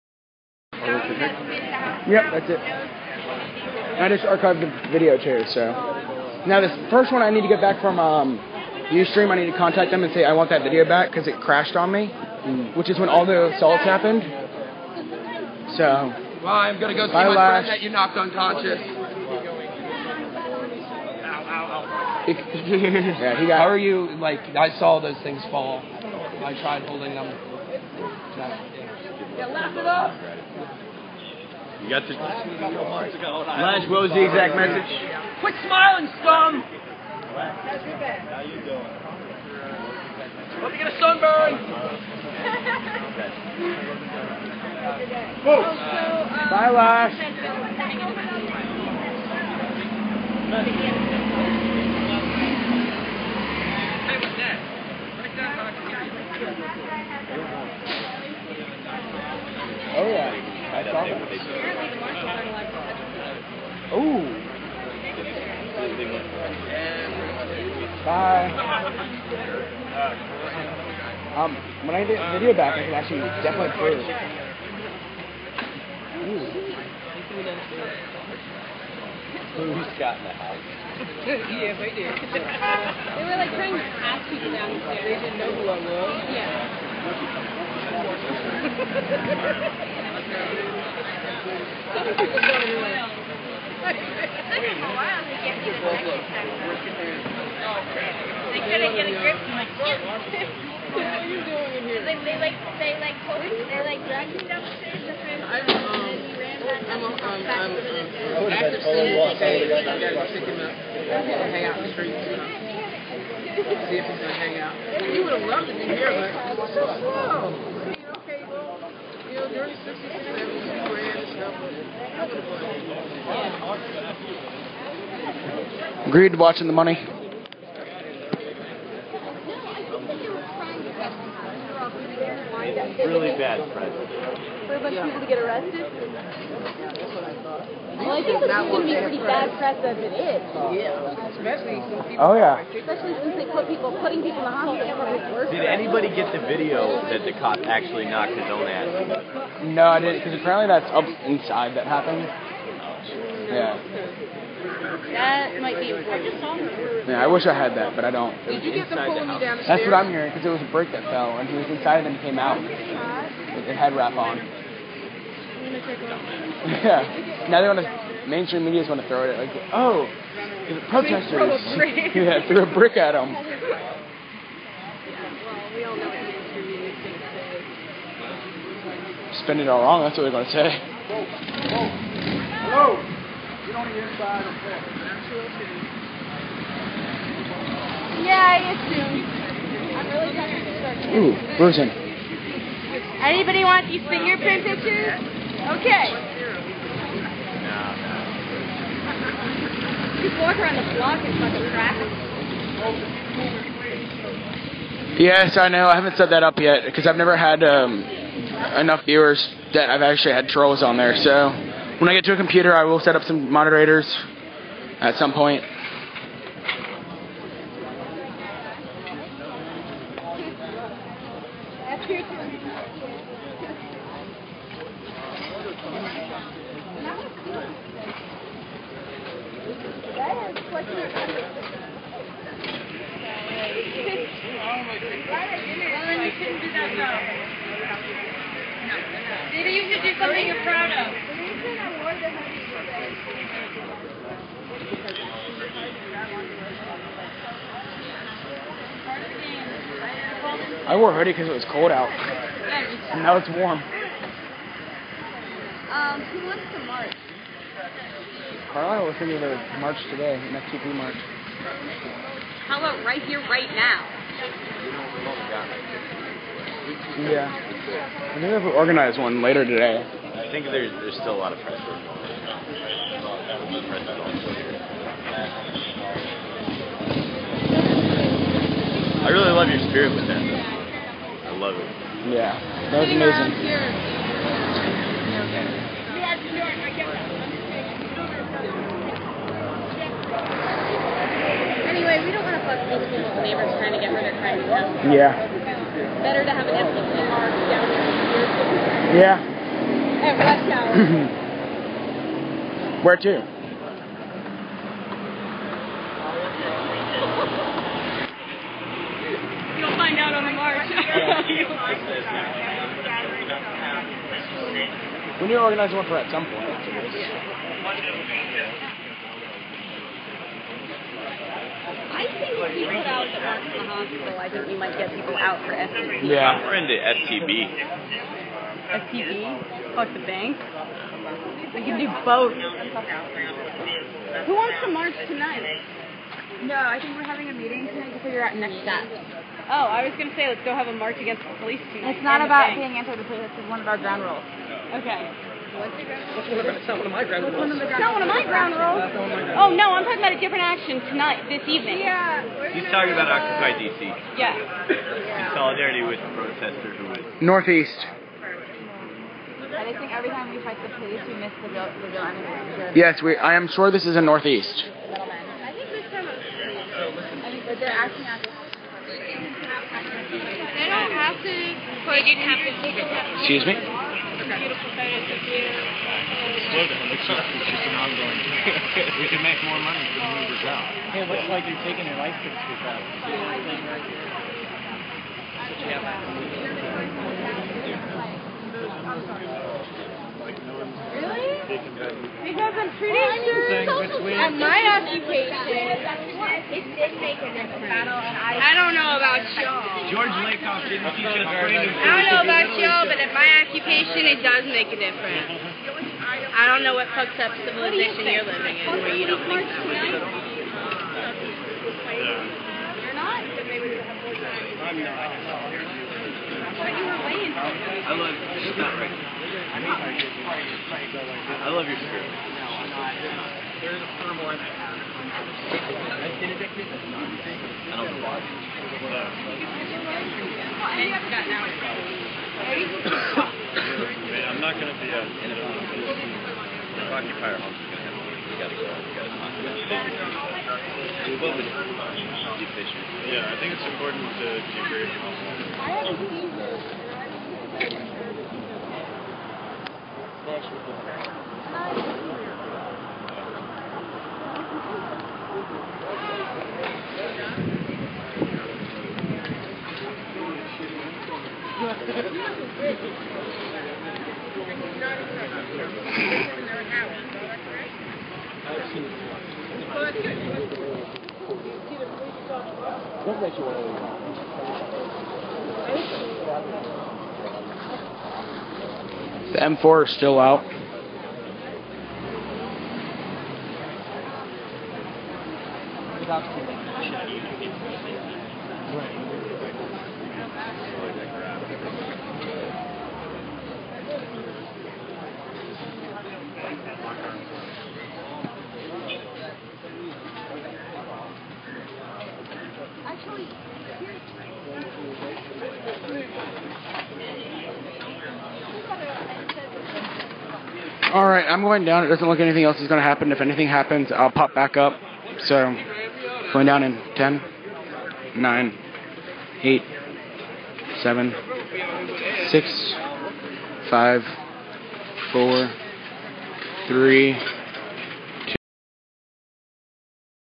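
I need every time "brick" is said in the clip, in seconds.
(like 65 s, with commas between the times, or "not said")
160 s, 172 s.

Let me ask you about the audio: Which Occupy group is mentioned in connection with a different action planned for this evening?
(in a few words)
Occupy DC.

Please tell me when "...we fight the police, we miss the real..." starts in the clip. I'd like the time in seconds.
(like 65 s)
360 s.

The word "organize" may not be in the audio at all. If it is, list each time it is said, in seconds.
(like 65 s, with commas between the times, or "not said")
268 s, 315 s.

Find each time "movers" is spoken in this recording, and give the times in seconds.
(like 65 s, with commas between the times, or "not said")
380 s.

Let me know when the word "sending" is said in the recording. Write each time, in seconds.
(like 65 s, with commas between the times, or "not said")
not said.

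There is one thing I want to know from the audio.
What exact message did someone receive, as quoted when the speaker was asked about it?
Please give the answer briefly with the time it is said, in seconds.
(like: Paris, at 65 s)
Quit smiling, scum, at 35 s.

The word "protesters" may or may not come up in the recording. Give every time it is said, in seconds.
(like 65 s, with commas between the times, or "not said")
170 s, 356 s.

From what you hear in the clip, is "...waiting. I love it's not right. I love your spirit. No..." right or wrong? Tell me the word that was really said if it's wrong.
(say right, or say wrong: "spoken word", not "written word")
right.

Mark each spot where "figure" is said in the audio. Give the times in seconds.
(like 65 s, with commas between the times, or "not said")
338 s.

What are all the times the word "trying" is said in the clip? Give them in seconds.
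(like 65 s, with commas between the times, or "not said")
83 s, 190 s, 293 s.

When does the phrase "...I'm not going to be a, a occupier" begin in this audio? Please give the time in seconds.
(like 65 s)
434 s.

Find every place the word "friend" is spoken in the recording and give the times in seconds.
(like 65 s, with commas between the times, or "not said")
17 s, 105 s.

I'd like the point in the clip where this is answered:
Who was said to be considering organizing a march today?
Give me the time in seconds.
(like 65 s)
258 s.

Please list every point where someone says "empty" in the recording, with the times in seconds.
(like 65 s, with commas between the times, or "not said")
296 s.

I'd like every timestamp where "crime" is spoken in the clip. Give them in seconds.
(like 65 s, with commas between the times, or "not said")
294 s.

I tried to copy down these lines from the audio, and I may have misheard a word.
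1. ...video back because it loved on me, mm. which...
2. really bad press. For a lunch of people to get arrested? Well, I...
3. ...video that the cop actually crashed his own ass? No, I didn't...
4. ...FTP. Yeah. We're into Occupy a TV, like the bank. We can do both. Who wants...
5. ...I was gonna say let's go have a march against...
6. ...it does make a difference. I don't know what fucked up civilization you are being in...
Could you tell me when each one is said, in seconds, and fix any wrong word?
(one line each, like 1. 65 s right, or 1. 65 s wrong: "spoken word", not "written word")
1. 10 s wrong: "crashed", not "loved"
2. 132 s wrong: "bunch", not "lunch"
3. 146 s wrong: "knocked", not "crashed"
4. 325 s wrong: "FTP", not "Occupy"
5. 339 s right
6. 404 s wrong: "living", not "being".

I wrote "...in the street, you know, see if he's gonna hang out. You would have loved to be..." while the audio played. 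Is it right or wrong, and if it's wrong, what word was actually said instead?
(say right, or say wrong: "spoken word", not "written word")
right.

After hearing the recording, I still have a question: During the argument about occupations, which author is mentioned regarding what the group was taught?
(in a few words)
George Lakoff.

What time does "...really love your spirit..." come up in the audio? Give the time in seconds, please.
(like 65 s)
279 s.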